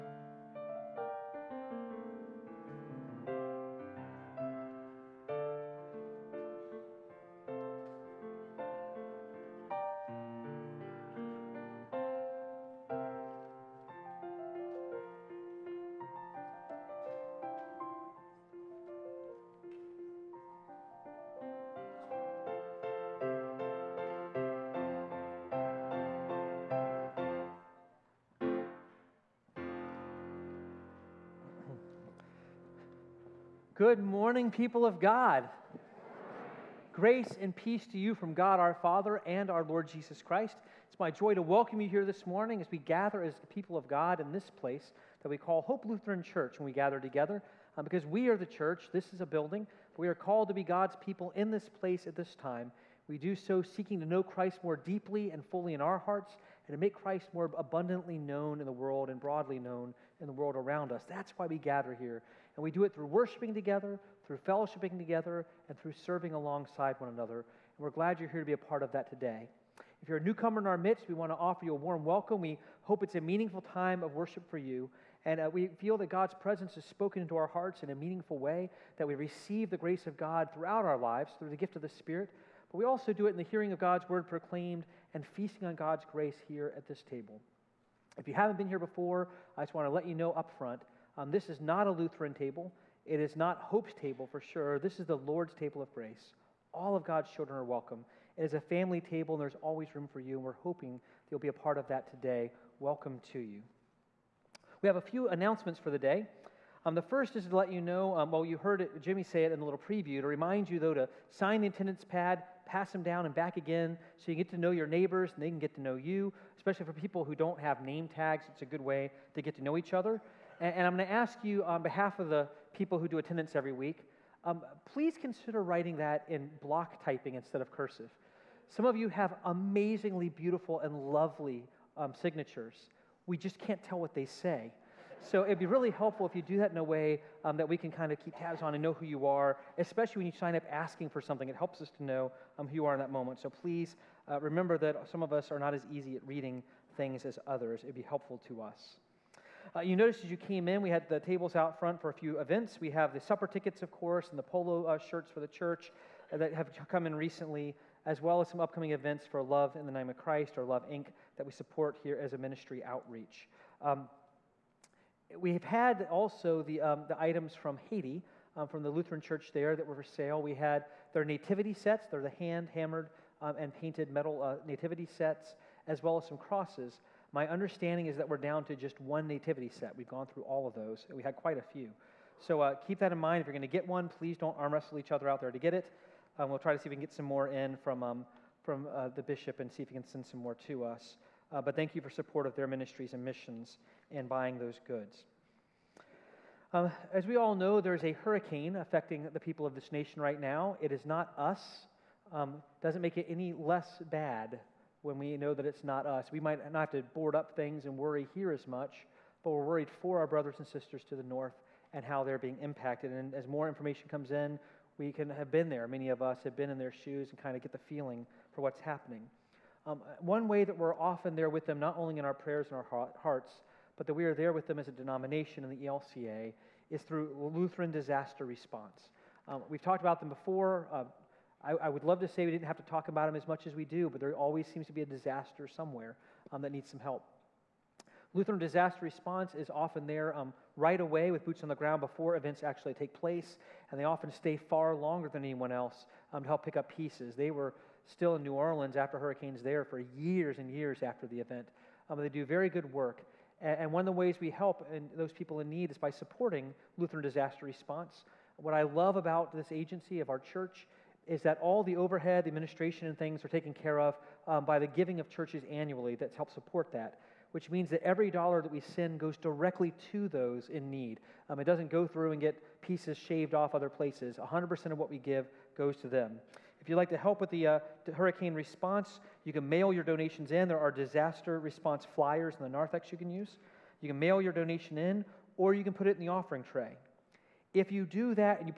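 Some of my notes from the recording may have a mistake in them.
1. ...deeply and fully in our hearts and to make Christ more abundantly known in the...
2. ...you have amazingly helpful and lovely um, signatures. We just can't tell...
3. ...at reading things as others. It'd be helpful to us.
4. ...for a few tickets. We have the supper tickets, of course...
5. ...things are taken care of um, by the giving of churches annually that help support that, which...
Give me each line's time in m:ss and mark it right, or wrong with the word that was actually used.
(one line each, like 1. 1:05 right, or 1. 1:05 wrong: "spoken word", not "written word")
1. 0:54 right
2. 2:08 wrong: "beautiful", not "helpful"
3. 2:26 right
4. 2:31 wrong: "events", not "tickets"
5. 4:23 right.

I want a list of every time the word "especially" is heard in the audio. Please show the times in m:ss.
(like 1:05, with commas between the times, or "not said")
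1:56, 2:19.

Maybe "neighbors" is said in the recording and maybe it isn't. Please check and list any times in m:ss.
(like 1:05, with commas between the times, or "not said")
1:54.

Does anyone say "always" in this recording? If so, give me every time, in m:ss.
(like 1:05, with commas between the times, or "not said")
1:39, 3:54.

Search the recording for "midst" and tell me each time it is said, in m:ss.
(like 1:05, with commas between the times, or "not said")
1:10.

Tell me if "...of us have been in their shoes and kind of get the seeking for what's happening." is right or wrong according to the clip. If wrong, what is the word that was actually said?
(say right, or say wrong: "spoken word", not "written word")
wrong: "feeling", not "seeking".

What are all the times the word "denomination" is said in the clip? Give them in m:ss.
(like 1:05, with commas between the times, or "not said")
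3:44.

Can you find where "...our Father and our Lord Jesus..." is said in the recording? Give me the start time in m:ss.
0:38.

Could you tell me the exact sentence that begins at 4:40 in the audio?
There are disaster response flyers in the narthex you can use.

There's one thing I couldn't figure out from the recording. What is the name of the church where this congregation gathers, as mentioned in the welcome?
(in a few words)
Hope Lutheran Church.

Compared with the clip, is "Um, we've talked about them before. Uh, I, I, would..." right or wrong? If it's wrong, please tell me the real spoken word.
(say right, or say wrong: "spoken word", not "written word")
right.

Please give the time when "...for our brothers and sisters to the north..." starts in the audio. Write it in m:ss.
3:29.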